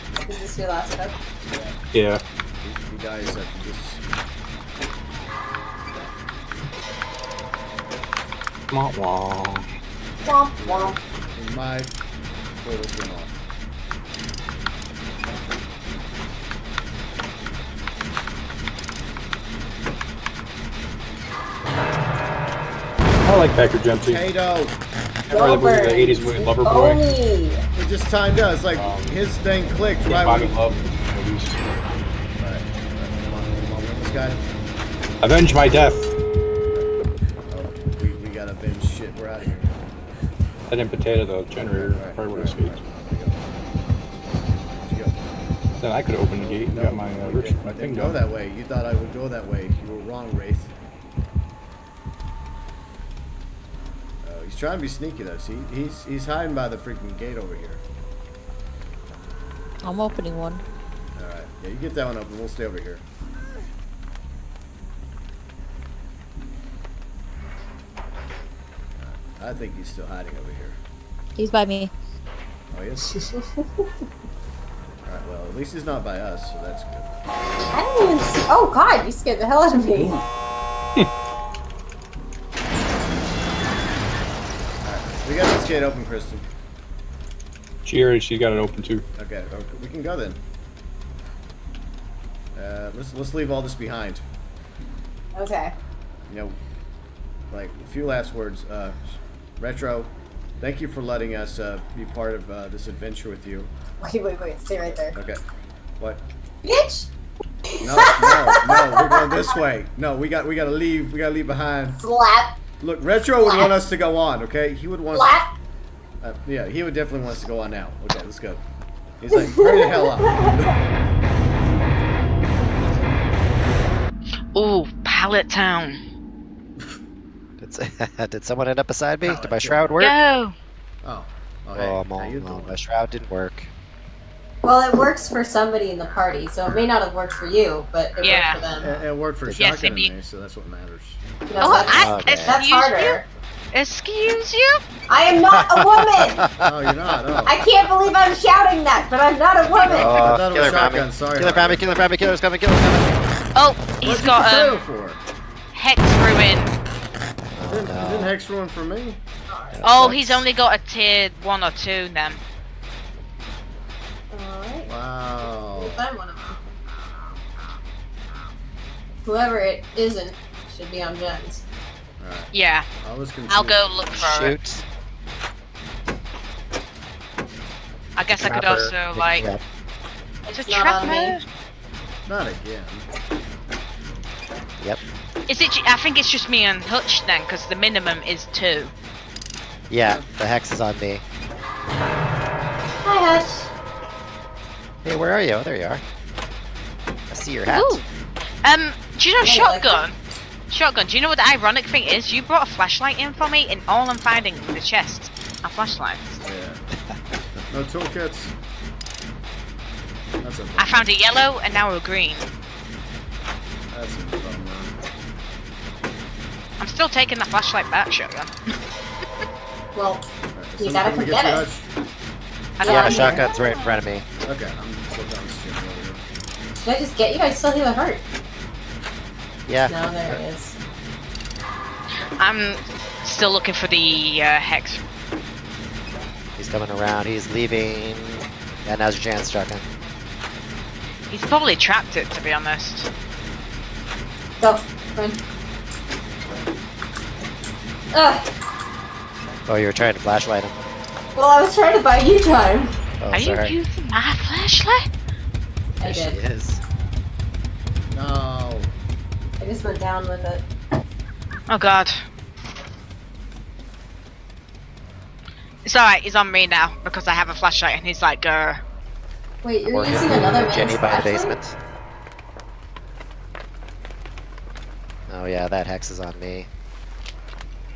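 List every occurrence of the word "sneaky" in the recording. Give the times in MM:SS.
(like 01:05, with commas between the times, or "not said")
00:54.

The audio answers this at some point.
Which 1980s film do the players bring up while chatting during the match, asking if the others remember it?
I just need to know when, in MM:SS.
00:26.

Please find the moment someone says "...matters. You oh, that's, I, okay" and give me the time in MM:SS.
02:20.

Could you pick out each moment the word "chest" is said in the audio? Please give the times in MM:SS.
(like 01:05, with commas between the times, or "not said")
03:24.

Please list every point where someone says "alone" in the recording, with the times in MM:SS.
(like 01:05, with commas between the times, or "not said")
02:12.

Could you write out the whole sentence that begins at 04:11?
Well, I was trying to buy you time.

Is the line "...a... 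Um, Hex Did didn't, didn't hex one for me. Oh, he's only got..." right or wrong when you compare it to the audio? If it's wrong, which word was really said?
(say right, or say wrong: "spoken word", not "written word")
wrong: "Ruin", not "Did".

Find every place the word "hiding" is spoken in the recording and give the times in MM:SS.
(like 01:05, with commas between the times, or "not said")
00:56, 01:10.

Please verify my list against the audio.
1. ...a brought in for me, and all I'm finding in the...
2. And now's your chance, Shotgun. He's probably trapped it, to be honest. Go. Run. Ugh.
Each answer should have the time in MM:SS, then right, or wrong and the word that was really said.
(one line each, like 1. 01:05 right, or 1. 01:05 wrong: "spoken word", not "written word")
1. 03:22 wrong: "flashlight", not "brought"
2. 03:58 right.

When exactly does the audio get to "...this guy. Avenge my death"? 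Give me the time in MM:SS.
00:34.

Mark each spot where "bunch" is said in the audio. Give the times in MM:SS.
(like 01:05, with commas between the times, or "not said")
not said.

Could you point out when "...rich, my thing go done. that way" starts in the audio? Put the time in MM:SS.
00:47.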